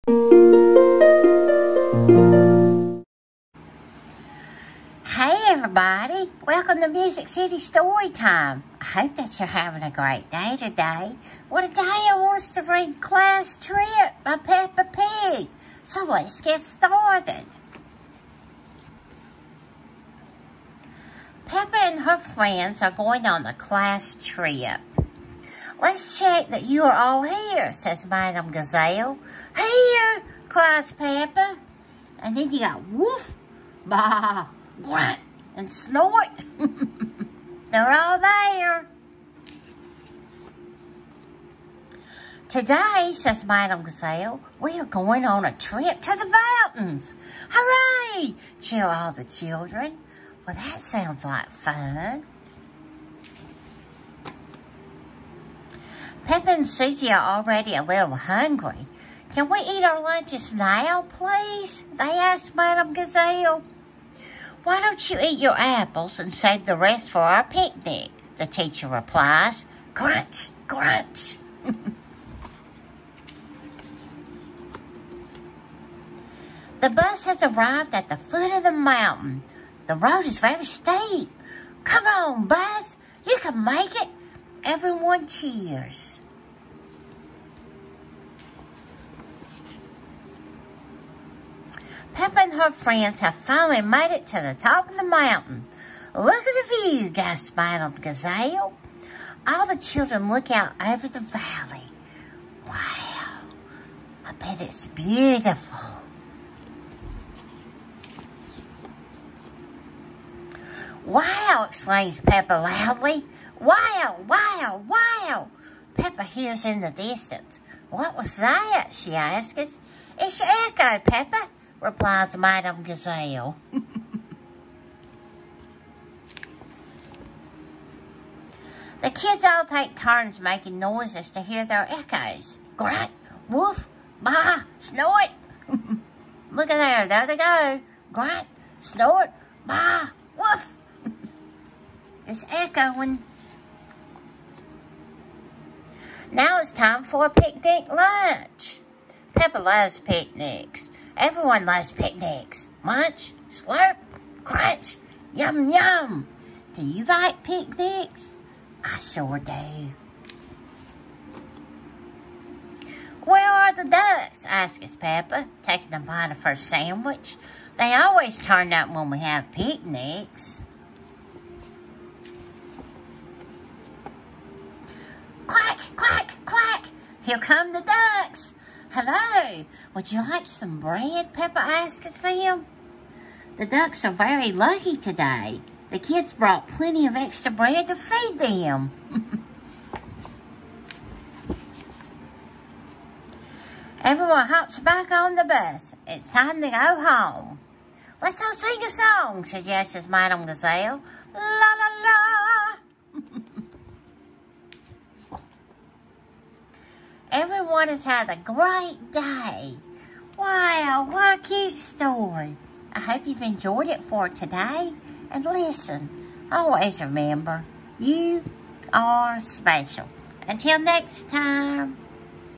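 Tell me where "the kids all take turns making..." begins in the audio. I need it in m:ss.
2:09.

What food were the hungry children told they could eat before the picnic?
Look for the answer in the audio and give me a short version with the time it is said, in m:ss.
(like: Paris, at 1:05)
apples, at 1:05.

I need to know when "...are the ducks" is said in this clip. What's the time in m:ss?
2:43.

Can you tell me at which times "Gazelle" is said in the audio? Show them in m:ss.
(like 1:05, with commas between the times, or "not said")
0:28, 0:43, 1:02, 1:37, 2:02, 3:20.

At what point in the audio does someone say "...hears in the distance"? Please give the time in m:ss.
1:56.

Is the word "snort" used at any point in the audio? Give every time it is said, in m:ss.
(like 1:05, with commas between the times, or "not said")
0:35, 2:14, 2:18.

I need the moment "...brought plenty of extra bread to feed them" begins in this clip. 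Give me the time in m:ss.
3:06.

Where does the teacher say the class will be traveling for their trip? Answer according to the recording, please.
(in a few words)
the mountains.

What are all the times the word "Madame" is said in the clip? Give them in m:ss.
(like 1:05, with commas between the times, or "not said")
0:28, 0:43, 1:02, 1:37, 2:02, 3:20.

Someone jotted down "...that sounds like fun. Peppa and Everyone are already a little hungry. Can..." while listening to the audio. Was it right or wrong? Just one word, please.
wrong.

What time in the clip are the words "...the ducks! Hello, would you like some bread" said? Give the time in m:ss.
2:57.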